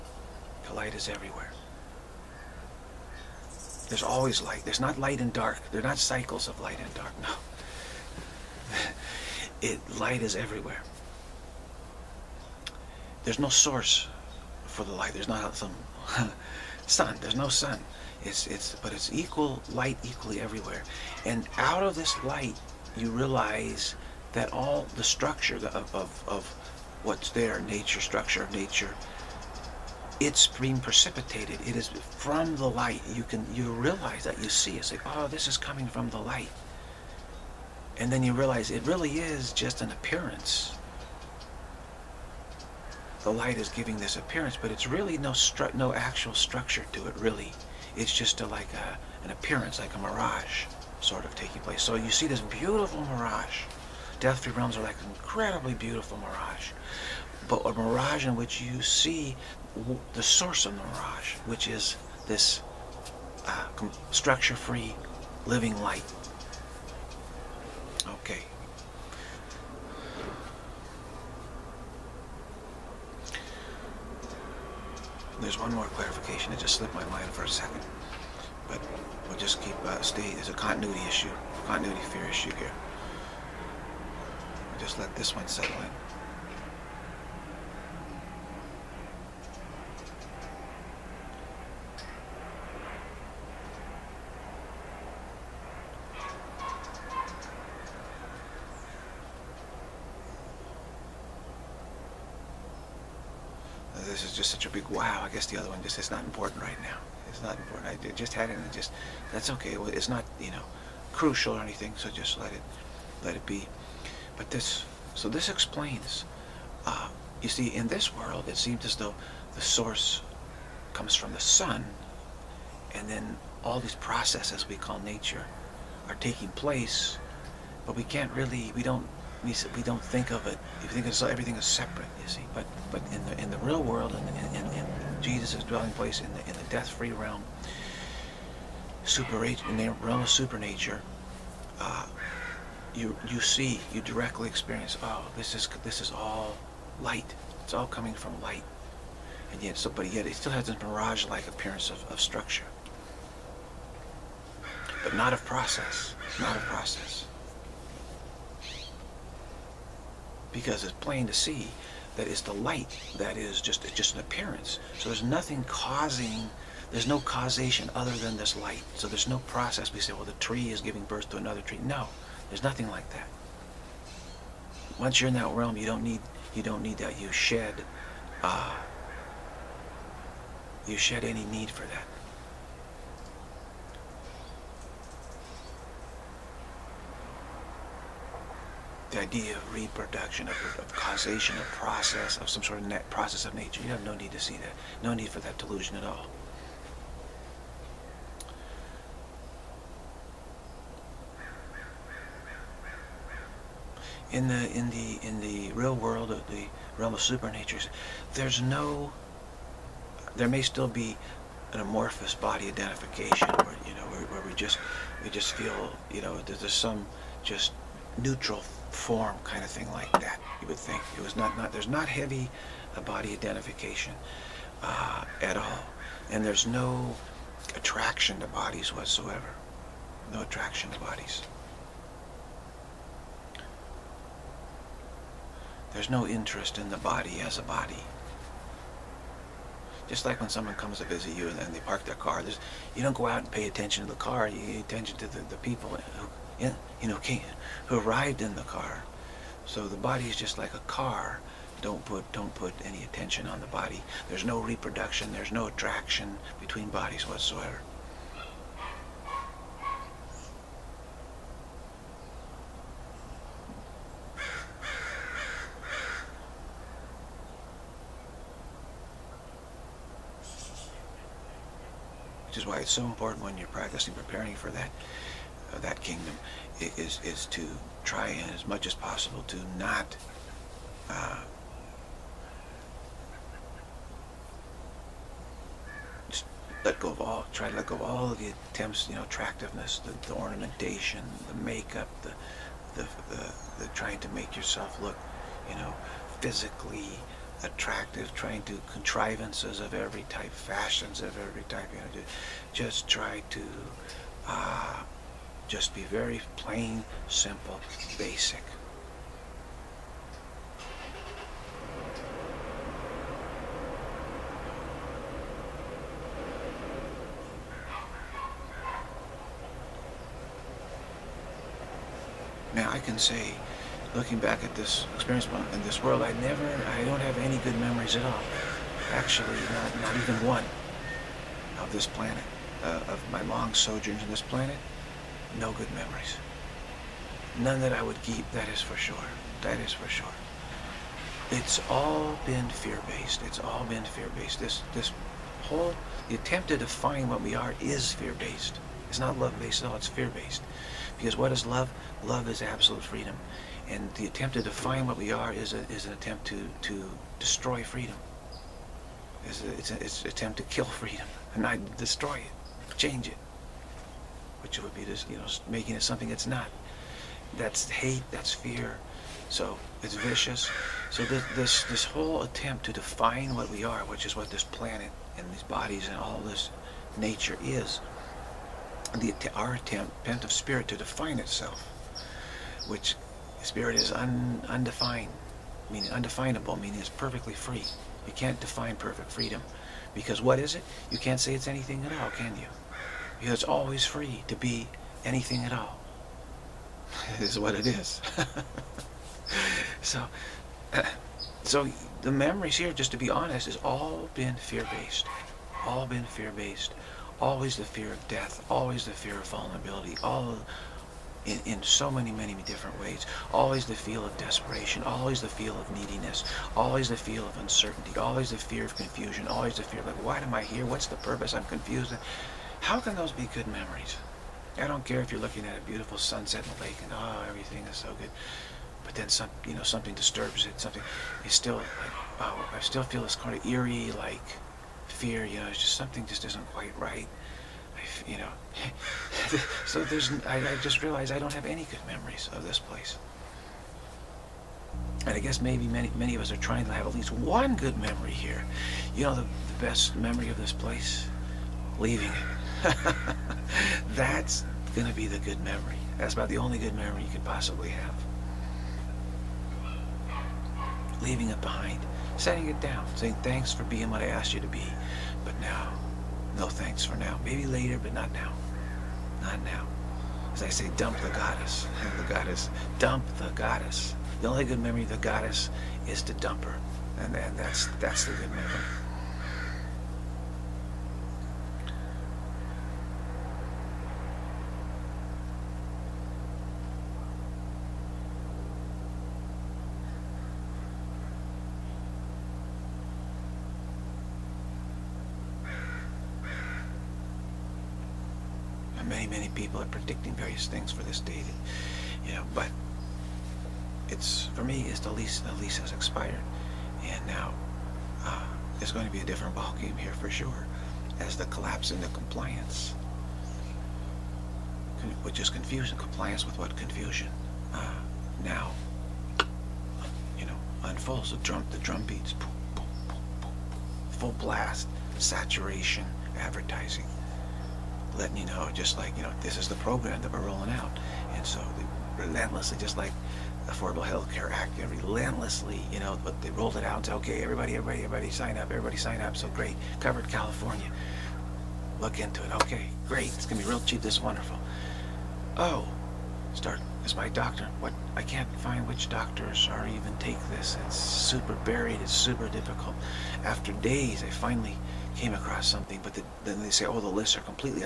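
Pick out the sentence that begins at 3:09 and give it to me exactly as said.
the idea of reproduction, of, of, causation, of process, of some sort of net process of nature.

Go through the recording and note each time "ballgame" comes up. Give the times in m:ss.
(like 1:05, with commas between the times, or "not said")
8:29.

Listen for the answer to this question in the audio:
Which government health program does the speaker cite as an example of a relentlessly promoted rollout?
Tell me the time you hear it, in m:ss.
8:53.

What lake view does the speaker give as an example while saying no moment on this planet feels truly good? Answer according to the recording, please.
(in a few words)
a beautiful sunset.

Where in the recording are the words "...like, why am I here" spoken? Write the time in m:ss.
7:00.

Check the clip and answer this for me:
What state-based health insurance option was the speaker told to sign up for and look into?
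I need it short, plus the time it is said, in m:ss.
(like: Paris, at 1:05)
Covered California, at 8:59.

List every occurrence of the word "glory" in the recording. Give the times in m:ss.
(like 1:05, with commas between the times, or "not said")
not said.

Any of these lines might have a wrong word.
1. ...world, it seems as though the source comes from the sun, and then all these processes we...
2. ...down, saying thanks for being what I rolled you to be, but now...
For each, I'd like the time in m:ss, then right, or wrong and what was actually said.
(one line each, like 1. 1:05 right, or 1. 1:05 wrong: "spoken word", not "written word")
1. 1:58 right
2. 7:42 wrong: "asked", not "rolled".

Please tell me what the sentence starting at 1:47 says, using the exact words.
I just had it and just, that's okay.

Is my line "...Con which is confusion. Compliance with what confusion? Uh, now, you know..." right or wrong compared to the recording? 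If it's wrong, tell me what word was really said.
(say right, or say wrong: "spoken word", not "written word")
right.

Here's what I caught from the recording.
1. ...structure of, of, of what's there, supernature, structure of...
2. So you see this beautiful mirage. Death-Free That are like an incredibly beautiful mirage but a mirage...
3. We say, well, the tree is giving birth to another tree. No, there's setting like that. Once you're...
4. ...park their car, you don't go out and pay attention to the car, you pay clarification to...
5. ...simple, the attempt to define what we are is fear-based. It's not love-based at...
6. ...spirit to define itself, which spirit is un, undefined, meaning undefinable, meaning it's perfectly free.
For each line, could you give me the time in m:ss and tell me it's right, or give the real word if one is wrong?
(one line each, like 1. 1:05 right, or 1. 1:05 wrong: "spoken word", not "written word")
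1. 0:25 wrong: "nature", not "supernature"
2. 0:51 wrong: "Realms", not "That"
3. 2:49 wrong: "nothing", not "setting"
4. 4:01 wrong: "attention", not "clarification"
5. 5:45 wrong: "whole", not "simple"
6. 6:20 right.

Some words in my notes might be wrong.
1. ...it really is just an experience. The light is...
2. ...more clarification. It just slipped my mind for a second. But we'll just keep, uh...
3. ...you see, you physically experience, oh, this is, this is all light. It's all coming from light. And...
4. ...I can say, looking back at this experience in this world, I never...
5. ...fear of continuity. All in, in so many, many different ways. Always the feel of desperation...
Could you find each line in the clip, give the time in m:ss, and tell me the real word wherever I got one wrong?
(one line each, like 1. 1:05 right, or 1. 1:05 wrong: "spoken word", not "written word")
1. 0:38 wrong: "appearance", not "experience"
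2. 1:15 right
3. 2:23 wrong: "directly", not "physically"
4. 5:22 right
5. 6:49 wrong: "vulnerability", not "continuity".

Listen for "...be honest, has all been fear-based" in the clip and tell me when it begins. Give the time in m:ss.
6:43.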